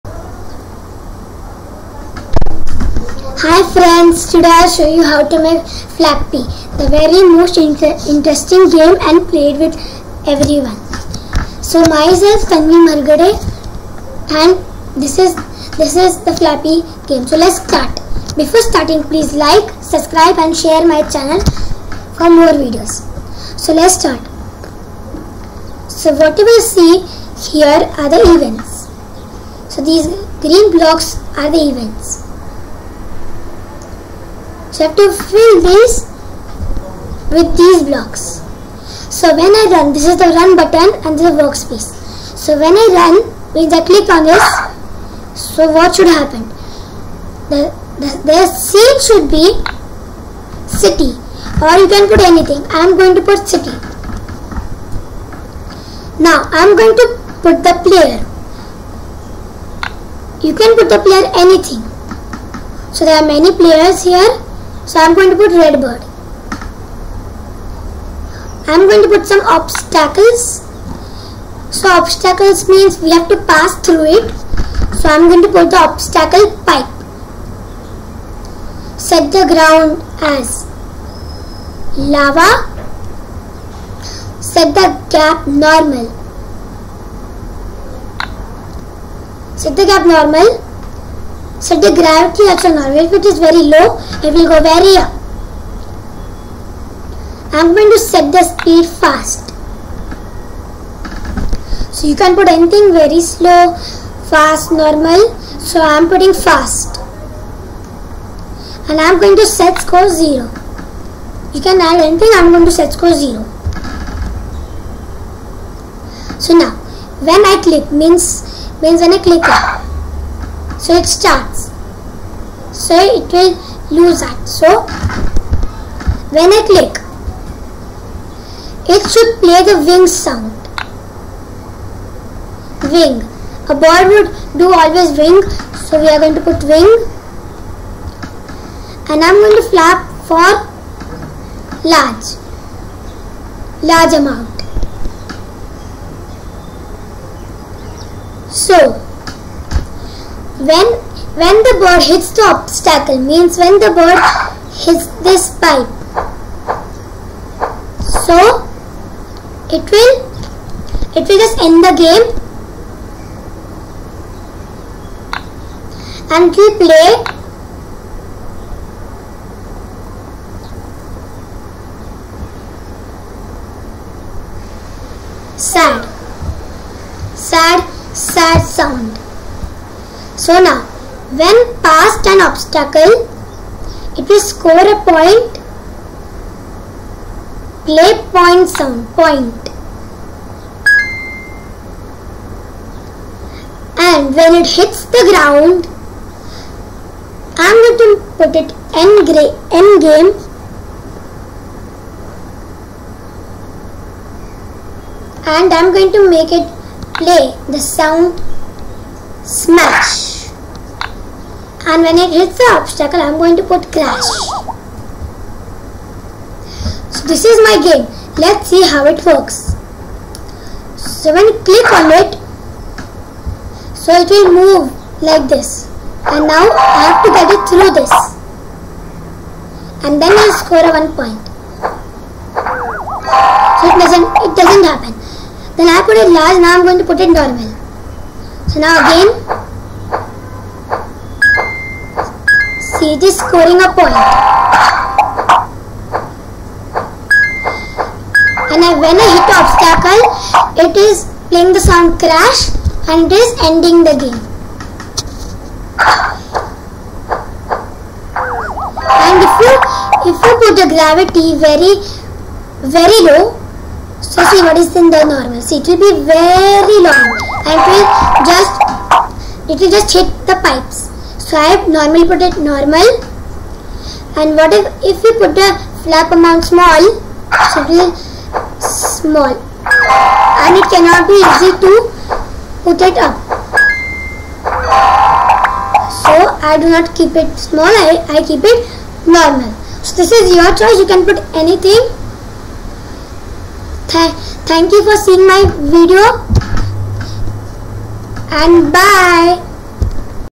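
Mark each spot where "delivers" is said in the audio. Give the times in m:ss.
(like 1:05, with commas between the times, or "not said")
not said.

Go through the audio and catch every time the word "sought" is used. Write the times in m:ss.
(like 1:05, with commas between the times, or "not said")
not said.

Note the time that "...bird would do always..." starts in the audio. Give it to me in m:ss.
2:13.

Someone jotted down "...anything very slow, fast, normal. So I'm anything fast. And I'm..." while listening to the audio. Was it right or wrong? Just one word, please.
wrong.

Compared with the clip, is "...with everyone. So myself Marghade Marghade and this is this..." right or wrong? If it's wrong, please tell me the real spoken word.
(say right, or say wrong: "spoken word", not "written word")
wrong: "Tanvi", not "Marghade".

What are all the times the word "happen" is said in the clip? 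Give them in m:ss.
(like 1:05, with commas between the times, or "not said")
0:46, 3:54.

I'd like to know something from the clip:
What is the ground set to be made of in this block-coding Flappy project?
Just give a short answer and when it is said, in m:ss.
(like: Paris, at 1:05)
Lava, at 1:18.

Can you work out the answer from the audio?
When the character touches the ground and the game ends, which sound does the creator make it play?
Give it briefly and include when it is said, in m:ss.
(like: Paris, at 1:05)
Smash, at 3:27.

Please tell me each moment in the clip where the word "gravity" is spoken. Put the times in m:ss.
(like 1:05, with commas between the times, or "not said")
1:31, 4:20.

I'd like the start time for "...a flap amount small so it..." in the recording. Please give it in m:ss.
4:35.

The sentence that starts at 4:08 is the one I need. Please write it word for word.
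And when I hit obstacle, it is playing the sound crash and it is ending the game.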